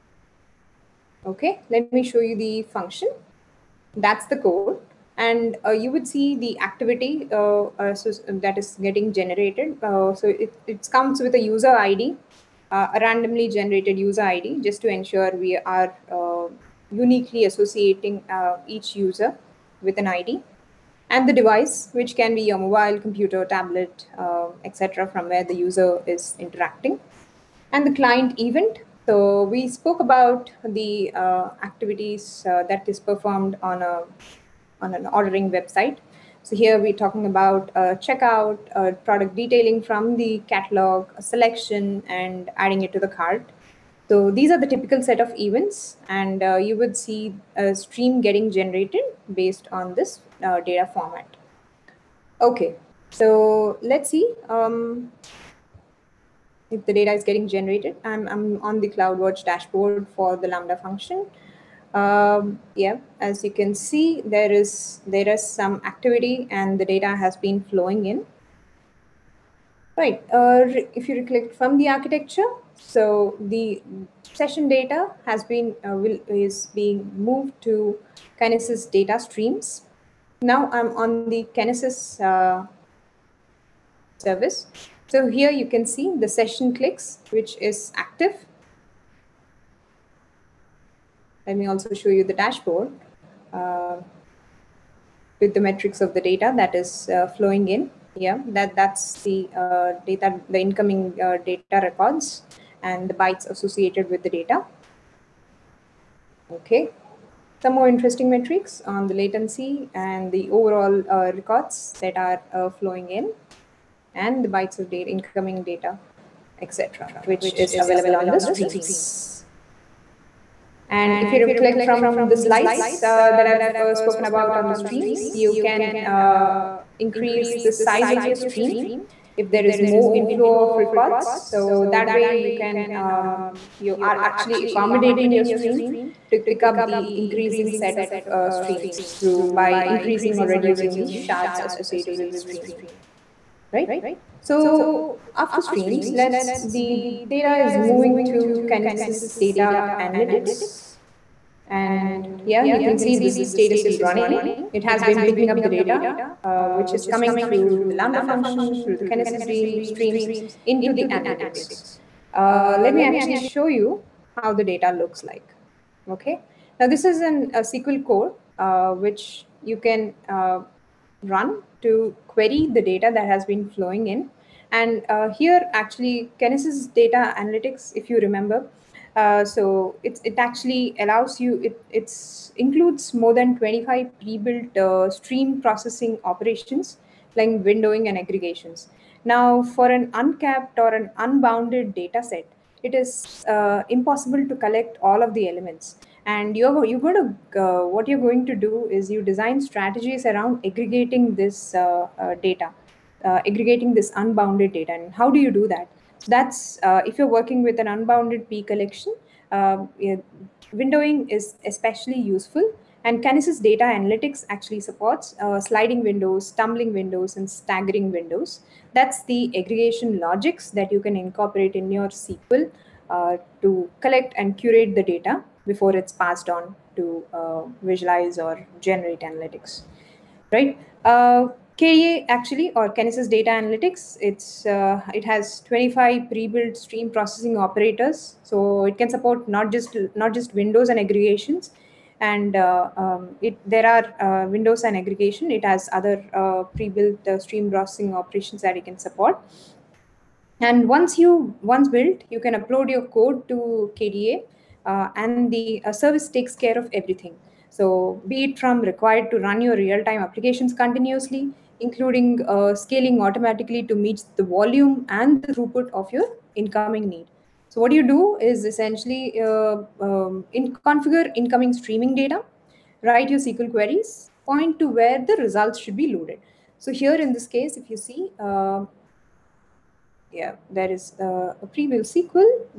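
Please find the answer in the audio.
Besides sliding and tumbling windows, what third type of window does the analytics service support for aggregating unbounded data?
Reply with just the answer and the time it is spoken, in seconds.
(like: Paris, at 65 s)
staggering windows, at 217 s.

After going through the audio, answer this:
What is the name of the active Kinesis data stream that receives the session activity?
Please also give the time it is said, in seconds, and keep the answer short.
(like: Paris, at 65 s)
session clicks, at 86 s.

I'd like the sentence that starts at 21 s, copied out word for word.
And the device, which can be your mobile, computer, tablet, etc., from where the user is interacting.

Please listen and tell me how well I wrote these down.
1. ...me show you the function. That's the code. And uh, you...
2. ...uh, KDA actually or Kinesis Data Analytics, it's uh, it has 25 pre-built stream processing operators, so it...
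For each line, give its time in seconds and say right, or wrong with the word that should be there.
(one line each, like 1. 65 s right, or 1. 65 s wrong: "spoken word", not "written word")
1. 1 s right
2. 231 s right.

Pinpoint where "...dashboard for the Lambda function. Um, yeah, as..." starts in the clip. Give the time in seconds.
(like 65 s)
59 s.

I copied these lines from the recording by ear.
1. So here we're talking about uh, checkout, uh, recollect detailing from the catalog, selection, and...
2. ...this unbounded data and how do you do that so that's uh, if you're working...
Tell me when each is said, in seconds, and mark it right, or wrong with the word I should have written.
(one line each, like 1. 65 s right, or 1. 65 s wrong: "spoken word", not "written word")
1. 36 s wrong: "product", not "recollect"
2. 203 s right.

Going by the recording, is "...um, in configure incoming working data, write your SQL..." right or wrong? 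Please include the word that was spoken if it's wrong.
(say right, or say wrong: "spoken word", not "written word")
wrong: "streaming", not "working".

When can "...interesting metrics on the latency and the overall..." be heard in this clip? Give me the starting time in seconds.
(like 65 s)
107 s.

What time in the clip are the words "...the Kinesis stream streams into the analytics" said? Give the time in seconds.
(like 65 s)
158 s.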